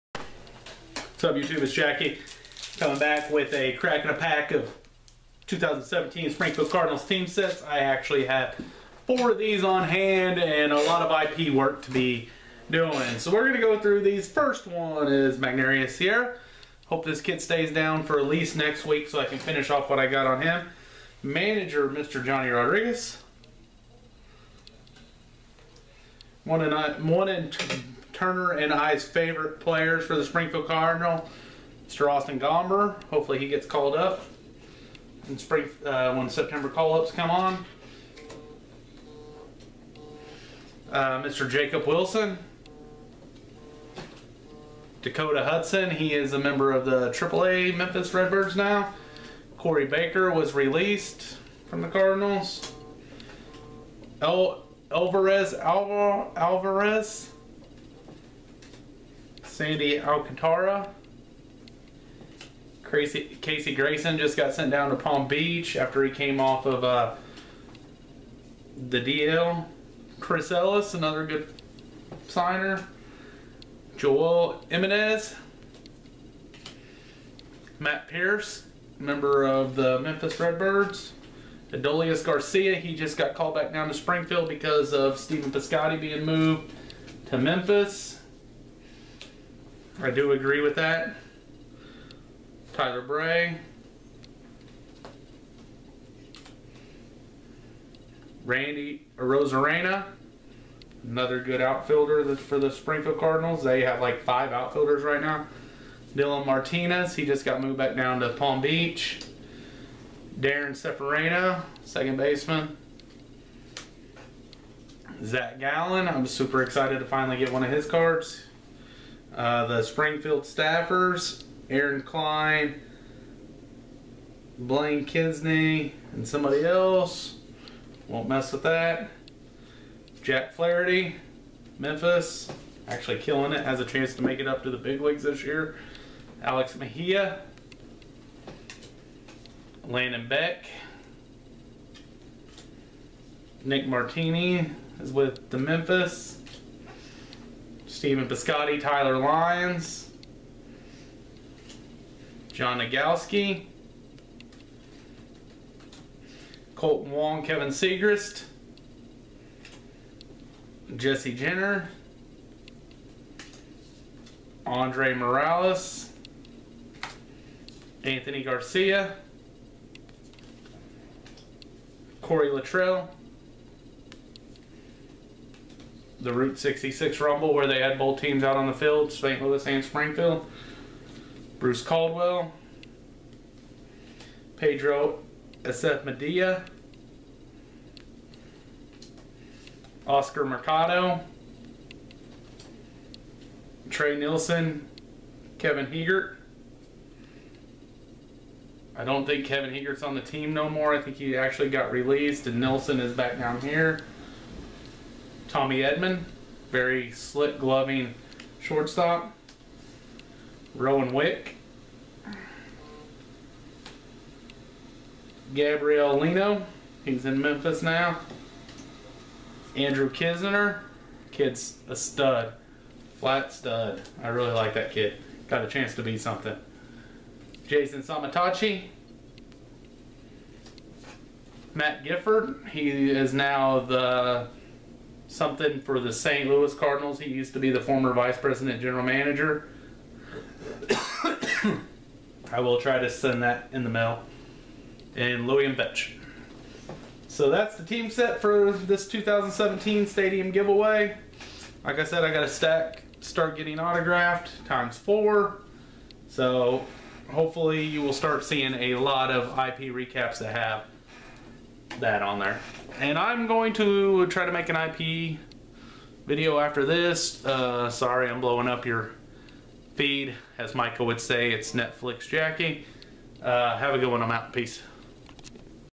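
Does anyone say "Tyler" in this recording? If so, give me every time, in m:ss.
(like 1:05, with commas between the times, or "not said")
1:32, 2:28.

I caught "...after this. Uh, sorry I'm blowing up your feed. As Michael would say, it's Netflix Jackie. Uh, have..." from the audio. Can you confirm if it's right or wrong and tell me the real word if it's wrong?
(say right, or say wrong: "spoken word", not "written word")
right.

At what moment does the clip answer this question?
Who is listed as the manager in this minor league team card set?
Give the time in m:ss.
0:22.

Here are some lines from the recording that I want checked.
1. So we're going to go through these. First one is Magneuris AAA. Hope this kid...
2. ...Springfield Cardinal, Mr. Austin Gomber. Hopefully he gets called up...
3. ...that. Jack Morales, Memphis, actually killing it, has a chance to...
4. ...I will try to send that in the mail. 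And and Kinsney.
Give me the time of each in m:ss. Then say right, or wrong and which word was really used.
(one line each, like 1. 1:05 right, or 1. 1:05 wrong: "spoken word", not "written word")
1. 0:13 wrong: "Sierra", not "AAA"
2. 0:30 right
3. 2:08 wrong: "Flaherty", not "Morales"
4. 4:02 wrong: "Vetch", not "Kinsney".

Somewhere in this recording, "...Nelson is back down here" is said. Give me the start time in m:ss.
3:22.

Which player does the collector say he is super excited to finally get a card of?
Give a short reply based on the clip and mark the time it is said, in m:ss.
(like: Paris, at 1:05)
Zac Gallen, at 1:55.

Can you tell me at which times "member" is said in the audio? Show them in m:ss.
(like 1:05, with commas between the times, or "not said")
0:46, 1:18.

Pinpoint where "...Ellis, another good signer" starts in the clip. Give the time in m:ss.
1:10.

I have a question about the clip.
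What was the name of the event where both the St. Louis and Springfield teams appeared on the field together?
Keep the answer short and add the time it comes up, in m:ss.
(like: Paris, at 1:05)
Route 66 Rumble, at 2:56.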